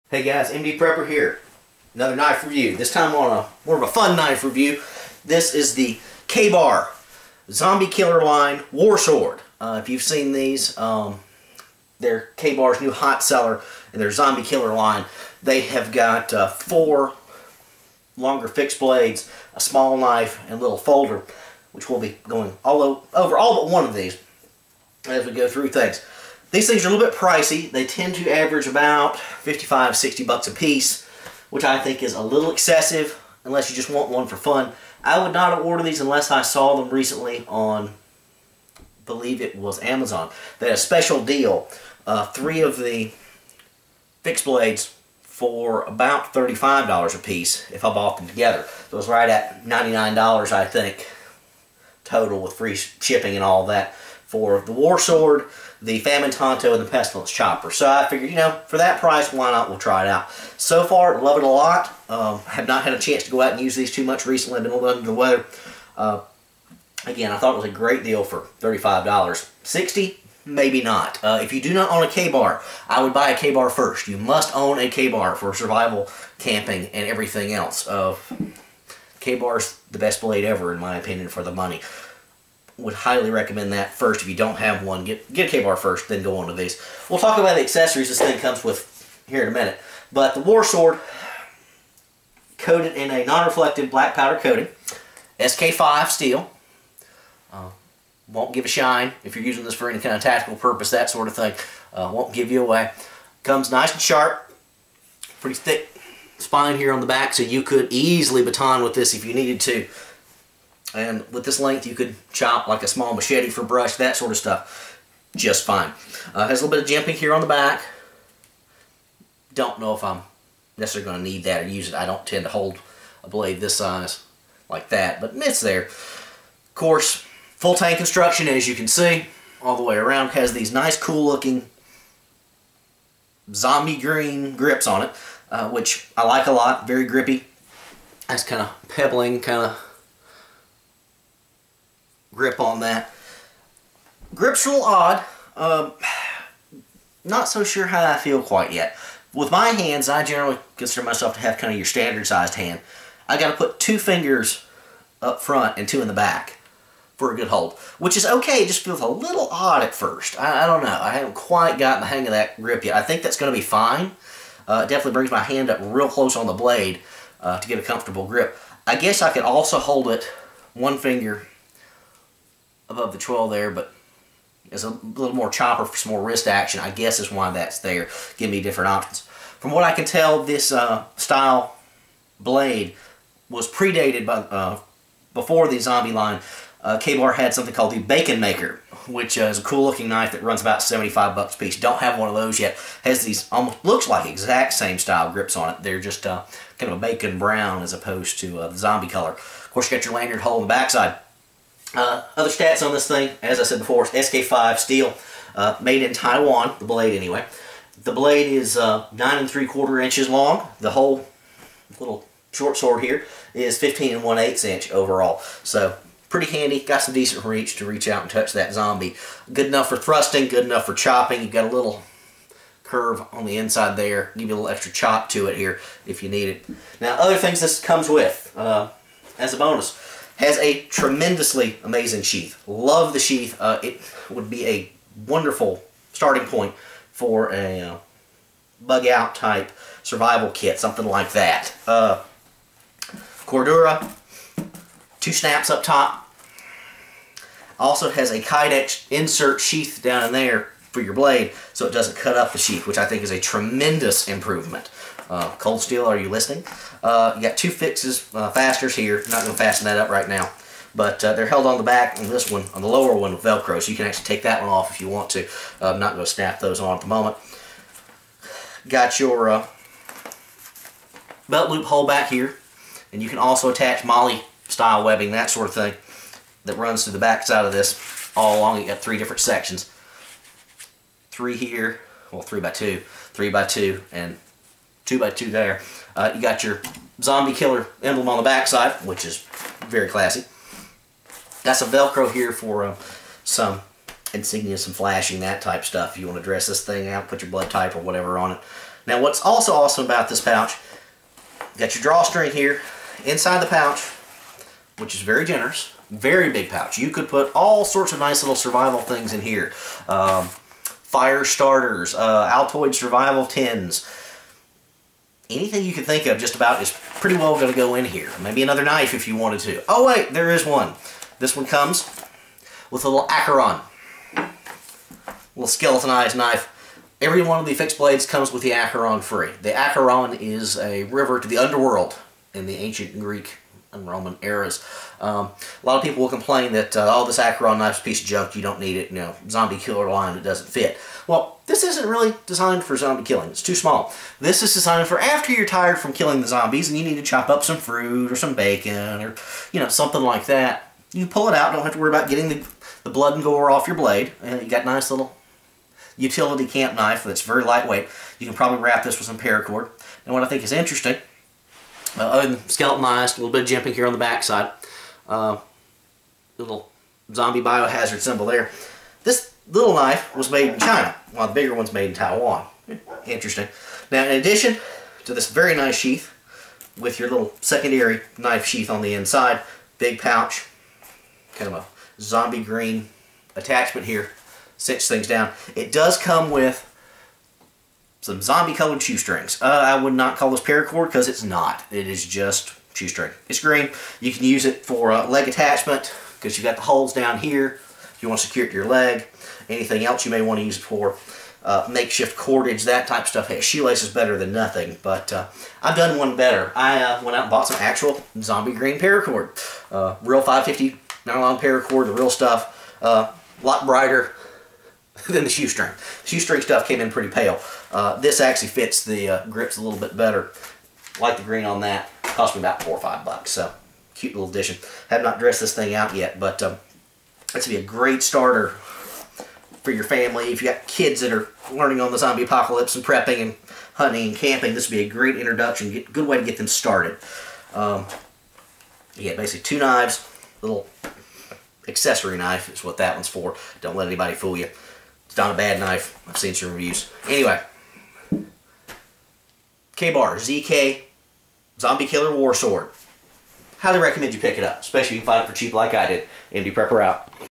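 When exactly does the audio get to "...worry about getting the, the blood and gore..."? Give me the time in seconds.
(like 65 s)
351 s.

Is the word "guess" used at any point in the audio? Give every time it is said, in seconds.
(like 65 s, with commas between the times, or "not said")
168 s, 176 s.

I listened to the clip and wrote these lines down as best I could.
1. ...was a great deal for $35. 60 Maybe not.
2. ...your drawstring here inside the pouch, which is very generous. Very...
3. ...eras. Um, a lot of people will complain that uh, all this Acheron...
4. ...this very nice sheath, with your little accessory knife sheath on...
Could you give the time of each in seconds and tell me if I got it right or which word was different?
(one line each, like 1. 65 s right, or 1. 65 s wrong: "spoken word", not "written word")
1. 67 s right
2. 301 s right
3. 334 s right
4. 375 s wrong: "secondary", not "accessory".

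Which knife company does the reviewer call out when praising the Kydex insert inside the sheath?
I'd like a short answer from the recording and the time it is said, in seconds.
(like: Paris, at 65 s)
Cold Steel, at 255 s.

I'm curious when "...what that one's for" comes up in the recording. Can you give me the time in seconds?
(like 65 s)
442 s.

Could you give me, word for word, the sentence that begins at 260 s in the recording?
But uh, they're held on the back, and this one, on the lower one, with Velcro.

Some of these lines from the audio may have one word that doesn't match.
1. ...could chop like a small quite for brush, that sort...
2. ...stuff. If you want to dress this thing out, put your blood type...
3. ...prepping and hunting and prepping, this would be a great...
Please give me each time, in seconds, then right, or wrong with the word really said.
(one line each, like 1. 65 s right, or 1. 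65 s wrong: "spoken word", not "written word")
1. 111 s wrong: "machete", not "quite"
2. 295 s right
3. 433 s wrong: "camping", not "prepping".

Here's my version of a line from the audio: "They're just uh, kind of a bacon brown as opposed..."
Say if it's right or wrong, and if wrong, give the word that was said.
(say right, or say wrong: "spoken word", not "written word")
right.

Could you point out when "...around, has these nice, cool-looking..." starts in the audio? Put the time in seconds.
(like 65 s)
129 s.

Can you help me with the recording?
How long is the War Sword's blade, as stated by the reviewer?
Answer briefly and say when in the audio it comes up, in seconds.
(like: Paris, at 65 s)
9 3/4 inches, at 209 s.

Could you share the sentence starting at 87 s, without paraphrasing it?
We'll talk about the accessories this thing comes with here in a minute.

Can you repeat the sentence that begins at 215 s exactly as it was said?
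So pretty handy, got some decent reach to reach out and touch that zombie.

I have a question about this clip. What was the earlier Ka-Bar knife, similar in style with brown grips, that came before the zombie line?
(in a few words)
Bacon Maker.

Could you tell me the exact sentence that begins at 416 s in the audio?
The shoestring stuff came in pretty pale.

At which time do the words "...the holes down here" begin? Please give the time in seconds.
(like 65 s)
396 s.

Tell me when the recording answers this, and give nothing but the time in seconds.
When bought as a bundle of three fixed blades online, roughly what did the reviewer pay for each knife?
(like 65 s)
46 s.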